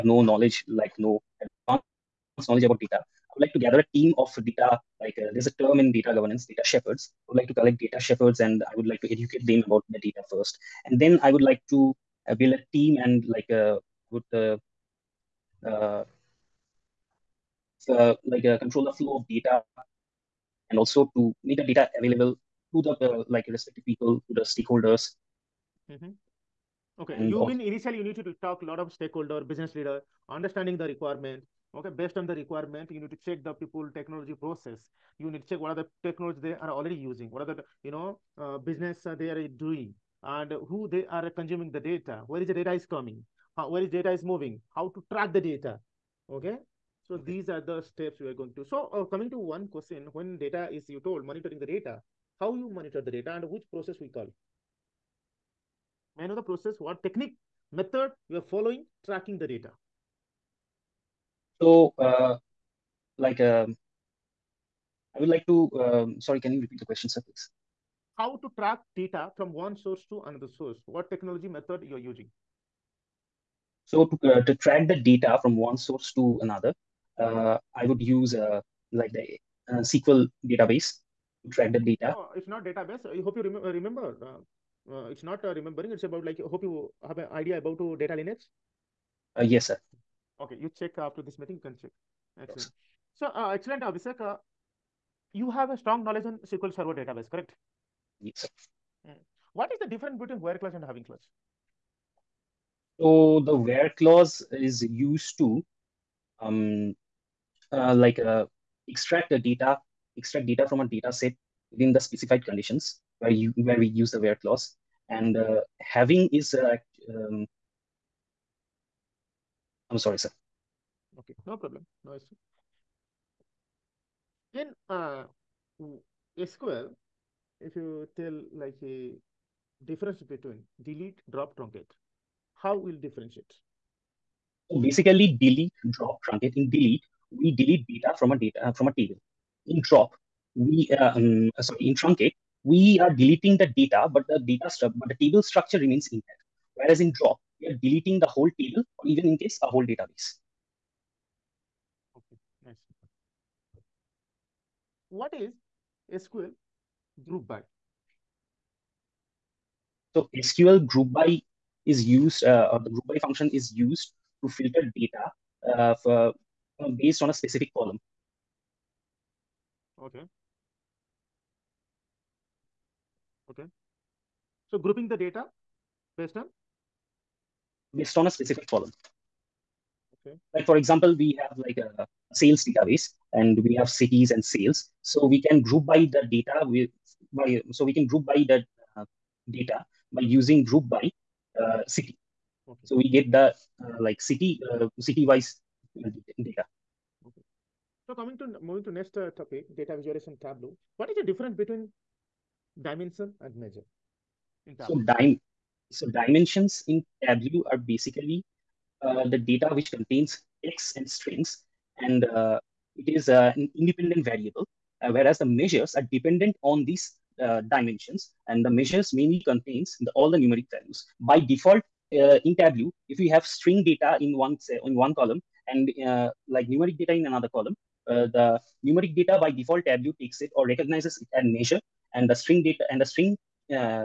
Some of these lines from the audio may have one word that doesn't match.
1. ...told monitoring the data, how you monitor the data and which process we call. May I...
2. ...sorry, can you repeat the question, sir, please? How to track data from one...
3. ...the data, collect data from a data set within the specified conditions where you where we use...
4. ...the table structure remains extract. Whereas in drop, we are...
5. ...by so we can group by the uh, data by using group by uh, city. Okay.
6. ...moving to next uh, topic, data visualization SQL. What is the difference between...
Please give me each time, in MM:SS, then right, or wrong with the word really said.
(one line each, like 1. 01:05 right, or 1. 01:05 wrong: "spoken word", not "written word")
1. 00:51 right
2. 01:06 right
3. 01:49 wrong: "extract", not "collect"
4. 02:25 wrong: "intact", not "extract"
5. 03:07 right
6. 03:18 wrong: "Tableau", not "SQL".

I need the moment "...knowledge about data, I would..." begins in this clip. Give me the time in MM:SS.
00:02.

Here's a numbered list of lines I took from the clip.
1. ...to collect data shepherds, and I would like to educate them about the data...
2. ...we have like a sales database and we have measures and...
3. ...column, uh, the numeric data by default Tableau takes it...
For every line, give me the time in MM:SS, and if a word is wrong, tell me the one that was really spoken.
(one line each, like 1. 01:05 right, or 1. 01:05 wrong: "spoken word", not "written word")
1. 00:07 right
2. 03:01 wrong: "cities", not "measures"
3. 03:47 right.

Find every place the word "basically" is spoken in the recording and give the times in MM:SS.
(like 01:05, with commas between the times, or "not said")
02:14, 03:27.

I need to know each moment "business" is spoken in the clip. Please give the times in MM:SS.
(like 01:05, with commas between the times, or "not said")
00:29, 00:38.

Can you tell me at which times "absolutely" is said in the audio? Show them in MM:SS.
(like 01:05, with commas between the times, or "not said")
not said.